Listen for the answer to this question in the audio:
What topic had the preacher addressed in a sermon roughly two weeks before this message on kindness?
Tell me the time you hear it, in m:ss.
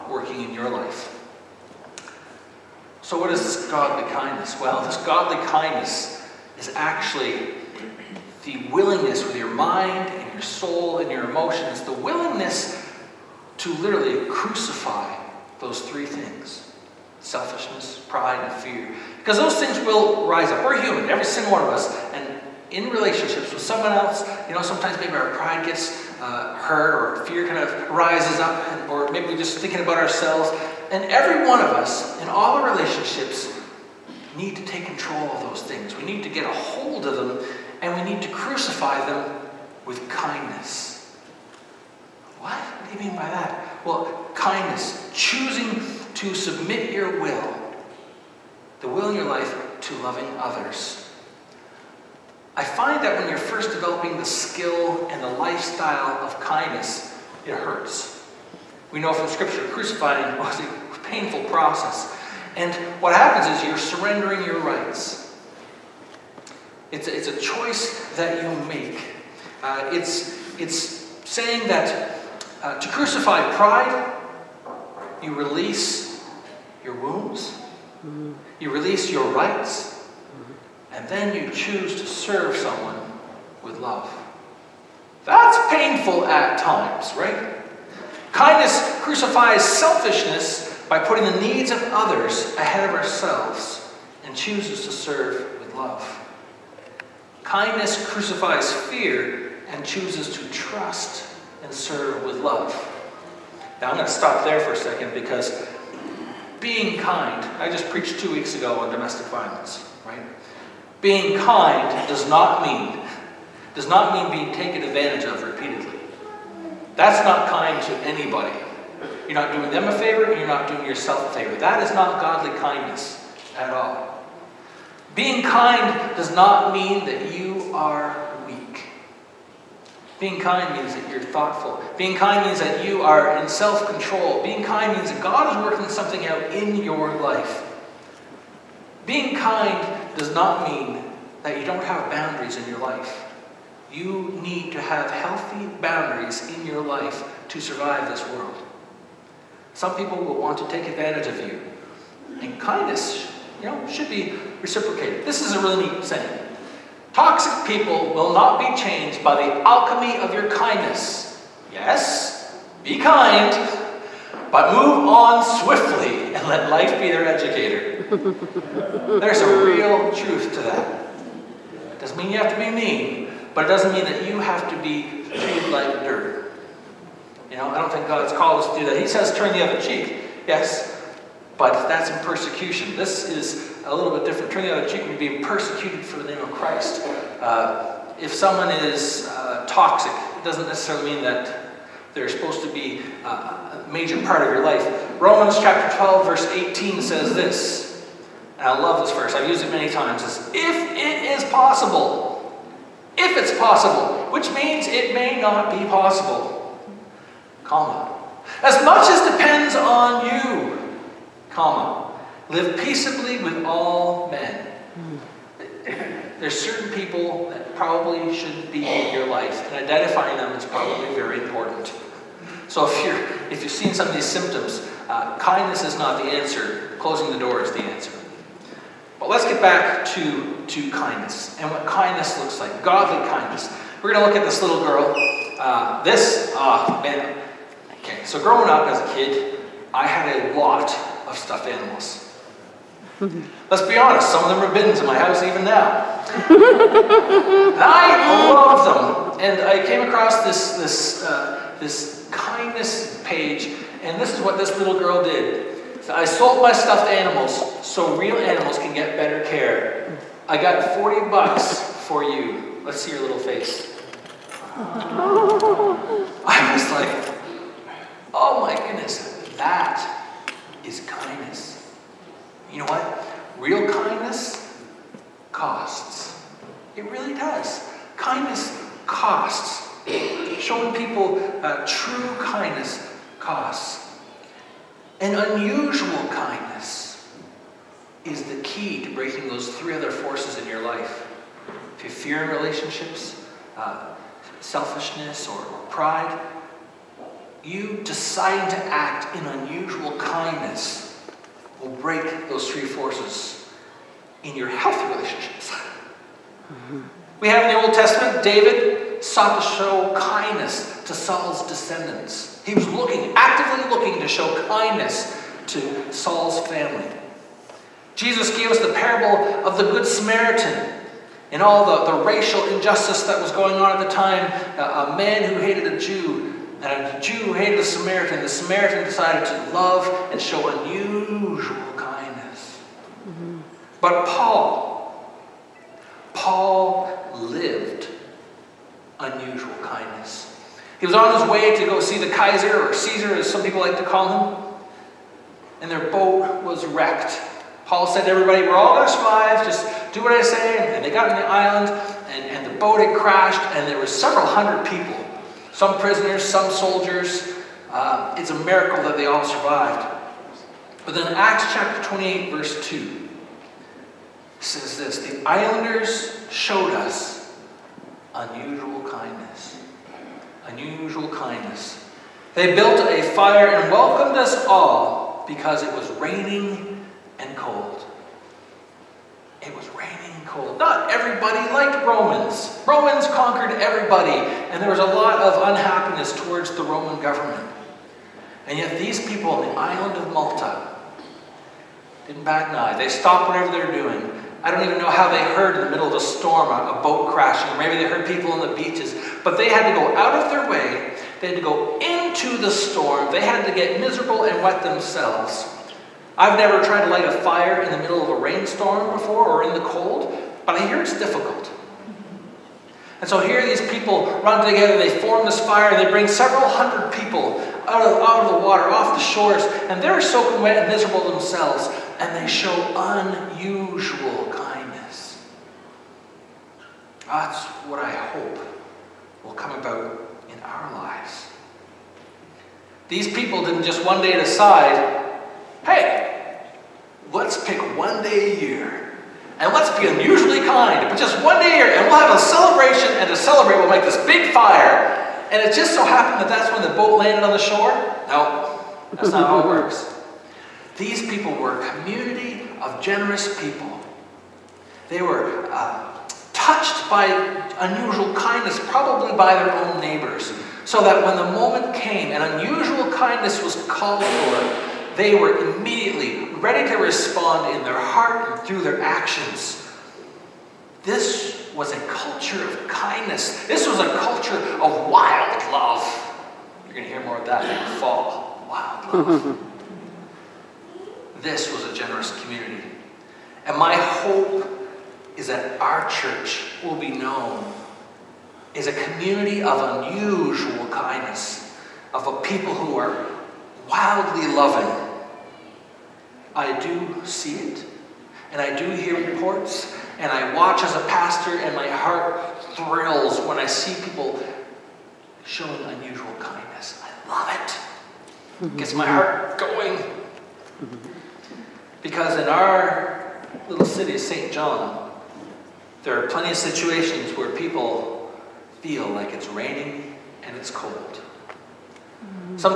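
1:48.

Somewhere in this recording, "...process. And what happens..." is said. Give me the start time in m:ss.
1:01.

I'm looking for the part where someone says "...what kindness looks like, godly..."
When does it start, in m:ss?
3:51.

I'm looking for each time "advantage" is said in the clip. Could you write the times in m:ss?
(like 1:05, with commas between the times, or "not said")
1:54, 2:30.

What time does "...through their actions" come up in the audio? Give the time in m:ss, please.
7:48.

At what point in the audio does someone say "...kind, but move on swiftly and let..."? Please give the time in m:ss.
2:42.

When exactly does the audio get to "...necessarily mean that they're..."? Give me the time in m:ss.
3:10.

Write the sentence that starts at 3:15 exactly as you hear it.
Romans chapter 12, verse 18 says this.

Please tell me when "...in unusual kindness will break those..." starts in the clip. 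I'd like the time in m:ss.
4:59.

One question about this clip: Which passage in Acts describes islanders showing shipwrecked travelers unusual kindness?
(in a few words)
Acts 28:2.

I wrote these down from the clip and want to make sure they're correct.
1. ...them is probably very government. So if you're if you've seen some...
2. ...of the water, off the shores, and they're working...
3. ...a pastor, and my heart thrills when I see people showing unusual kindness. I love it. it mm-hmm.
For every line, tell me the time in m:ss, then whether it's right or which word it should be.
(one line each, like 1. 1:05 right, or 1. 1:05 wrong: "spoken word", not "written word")
1. 3:40 wrong: "important", not "government"
2. 6:58 wrong: "soaking", not "working"
3. 8:20 right.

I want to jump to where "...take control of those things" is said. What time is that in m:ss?
0:34.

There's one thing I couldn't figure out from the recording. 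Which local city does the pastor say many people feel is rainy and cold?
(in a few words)
St. John.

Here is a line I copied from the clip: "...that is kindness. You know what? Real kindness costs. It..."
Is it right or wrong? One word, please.
right.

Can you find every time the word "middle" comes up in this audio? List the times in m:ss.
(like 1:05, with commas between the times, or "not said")
6:35, 6:47.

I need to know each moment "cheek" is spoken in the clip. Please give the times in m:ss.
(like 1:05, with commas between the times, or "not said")
2:59, 3:04.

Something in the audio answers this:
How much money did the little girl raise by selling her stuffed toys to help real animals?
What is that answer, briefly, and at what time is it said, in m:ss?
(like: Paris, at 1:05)
$40, at 4:20.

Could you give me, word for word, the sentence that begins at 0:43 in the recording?
Well, kindness, choosing to submit your will, the will in your life, to loving others.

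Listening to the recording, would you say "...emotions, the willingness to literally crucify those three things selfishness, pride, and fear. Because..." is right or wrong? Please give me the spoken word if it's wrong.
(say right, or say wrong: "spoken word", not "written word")
right.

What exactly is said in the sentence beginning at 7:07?
That's what I hope will come about in our lives.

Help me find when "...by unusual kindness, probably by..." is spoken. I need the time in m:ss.
7:37.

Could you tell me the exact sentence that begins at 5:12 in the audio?
He was looking, actively looking to show kindness to Saul's family.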